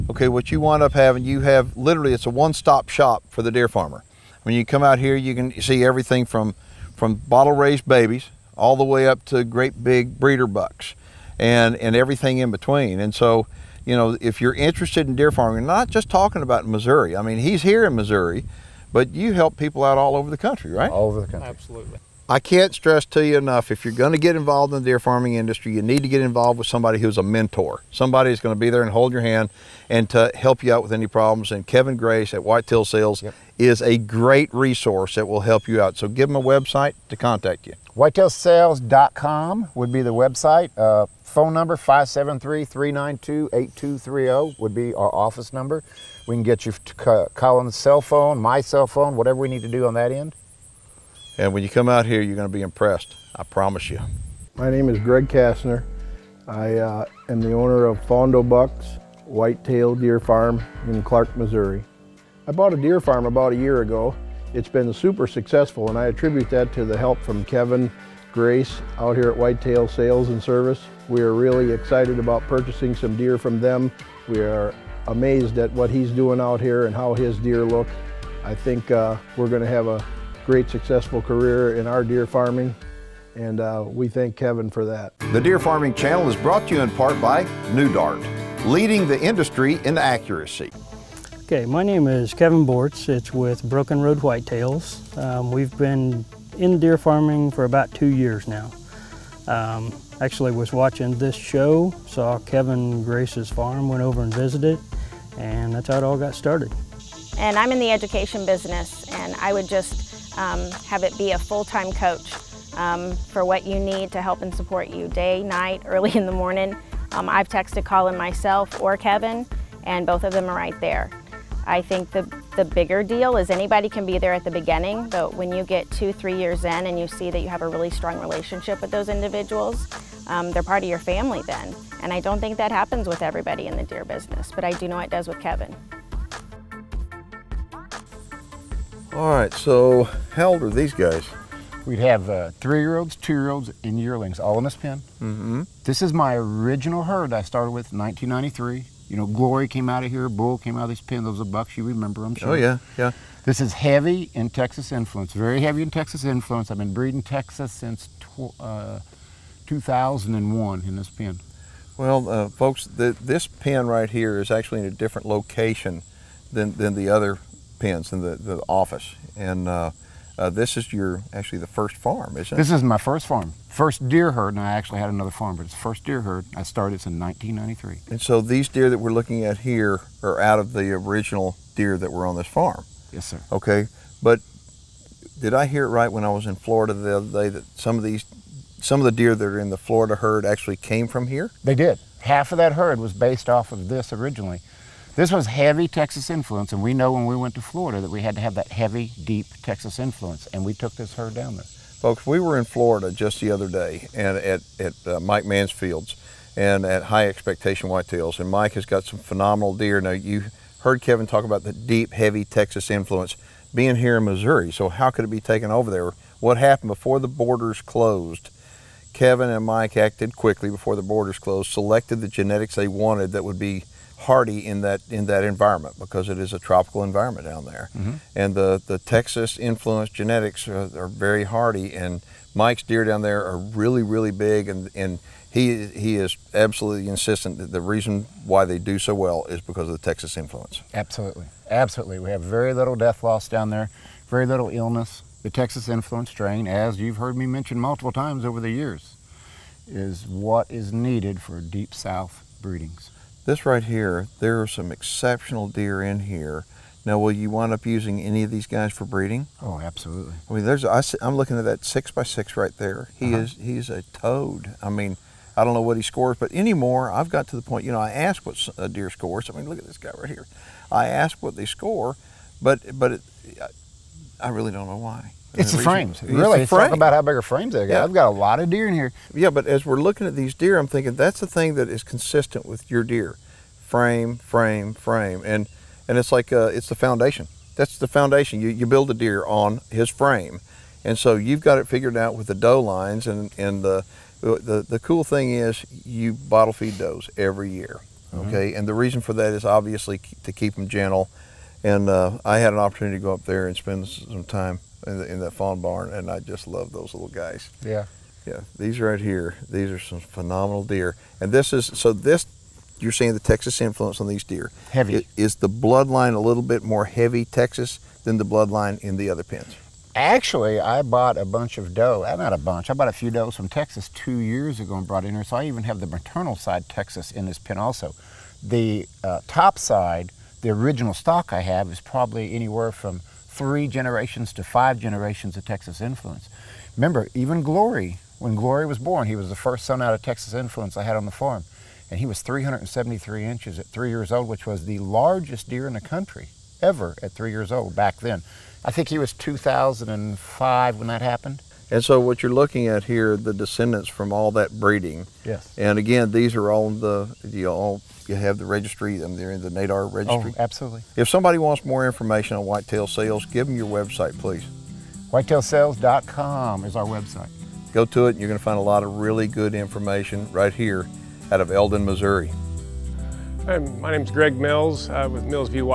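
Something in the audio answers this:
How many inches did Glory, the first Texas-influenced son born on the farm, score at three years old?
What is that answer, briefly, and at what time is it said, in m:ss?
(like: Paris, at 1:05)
373, at 5:42.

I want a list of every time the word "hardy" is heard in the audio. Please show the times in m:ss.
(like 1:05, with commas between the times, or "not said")
3:44, 3:51.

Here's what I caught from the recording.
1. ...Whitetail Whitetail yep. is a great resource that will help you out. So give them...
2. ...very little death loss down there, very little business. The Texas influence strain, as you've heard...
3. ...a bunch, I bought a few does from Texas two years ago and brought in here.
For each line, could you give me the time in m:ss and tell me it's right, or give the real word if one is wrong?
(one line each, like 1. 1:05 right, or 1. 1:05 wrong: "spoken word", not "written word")
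1. 0:32 wrong: "Sales", not "Whitetail"
2. 4:02 wrong: "illness", not "business"
3. 5:22 right.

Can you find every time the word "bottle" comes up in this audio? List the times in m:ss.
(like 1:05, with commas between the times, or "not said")
0:07, 4:56.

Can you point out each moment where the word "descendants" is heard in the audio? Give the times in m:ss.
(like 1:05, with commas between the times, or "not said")
5:53.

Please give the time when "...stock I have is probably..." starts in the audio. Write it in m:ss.
5:31.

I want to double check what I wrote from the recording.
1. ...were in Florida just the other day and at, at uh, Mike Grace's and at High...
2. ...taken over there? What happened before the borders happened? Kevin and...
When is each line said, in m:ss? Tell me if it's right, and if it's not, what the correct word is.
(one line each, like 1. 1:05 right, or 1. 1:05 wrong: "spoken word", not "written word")
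1. 3:22 wrong: "Mansfield", not "Grace"
2. 3:35 wrong: "closed", not "happened".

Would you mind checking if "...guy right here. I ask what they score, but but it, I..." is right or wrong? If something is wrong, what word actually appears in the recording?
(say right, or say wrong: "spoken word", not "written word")
right.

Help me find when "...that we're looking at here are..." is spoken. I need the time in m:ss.
2:58.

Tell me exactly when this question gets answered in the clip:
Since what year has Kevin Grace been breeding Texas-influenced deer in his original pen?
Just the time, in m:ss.
2:39.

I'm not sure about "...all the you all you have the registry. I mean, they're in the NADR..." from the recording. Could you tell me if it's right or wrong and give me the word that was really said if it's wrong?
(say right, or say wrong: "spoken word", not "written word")
right.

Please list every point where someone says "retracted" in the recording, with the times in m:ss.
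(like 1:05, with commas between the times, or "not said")
not said.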